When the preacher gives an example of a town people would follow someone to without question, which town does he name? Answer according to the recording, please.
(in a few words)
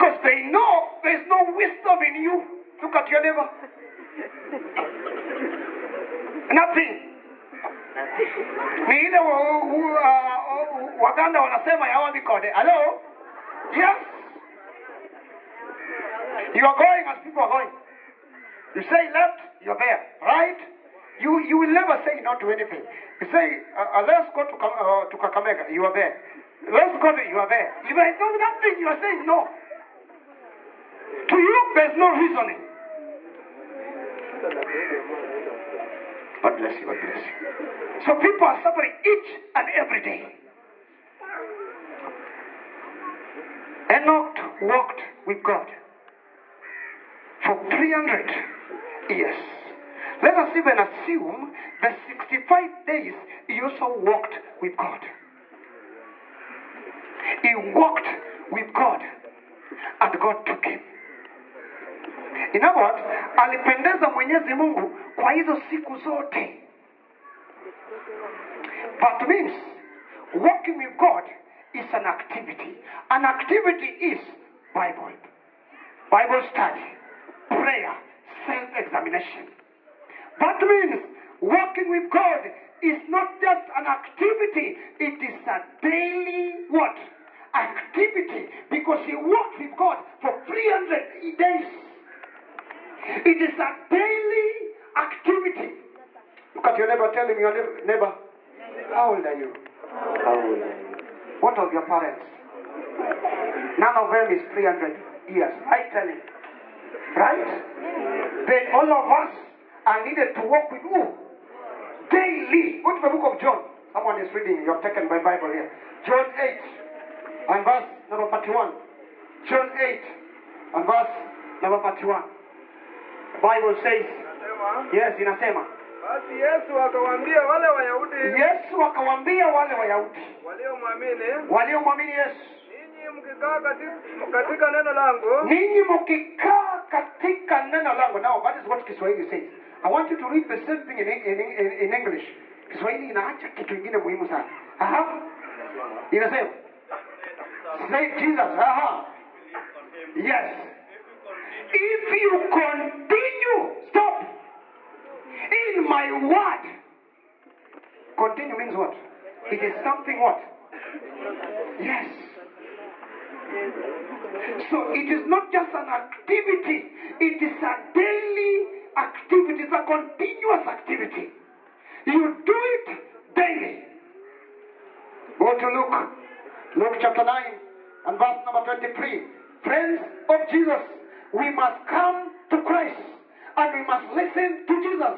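Kakamega.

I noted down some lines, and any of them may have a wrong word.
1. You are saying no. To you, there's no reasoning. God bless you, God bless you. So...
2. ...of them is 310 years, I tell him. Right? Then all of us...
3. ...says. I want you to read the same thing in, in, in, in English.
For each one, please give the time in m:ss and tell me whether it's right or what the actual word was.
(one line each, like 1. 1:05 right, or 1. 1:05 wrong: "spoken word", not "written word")
1. 0:28 right
2. 1:43 wrong: "300", not "310"
3. 2:19 right.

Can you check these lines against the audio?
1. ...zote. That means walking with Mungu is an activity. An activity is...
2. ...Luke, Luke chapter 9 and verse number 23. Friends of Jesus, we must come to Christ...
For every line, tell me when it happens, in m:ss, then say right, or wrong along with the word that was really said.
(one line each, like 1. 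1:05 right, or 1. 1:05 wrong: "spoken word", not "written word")
1. 1:05 wrong: "God", not "Mungu"
2. 2:55 right.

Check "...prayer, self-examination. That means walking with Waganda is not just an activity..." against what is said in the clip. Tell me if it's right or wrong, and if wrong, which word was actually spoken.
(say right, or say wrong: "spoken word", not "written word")
wrong: "God", not "Waganda".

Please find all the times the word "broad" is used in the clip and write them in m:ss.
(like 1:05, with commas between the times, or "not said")
not said.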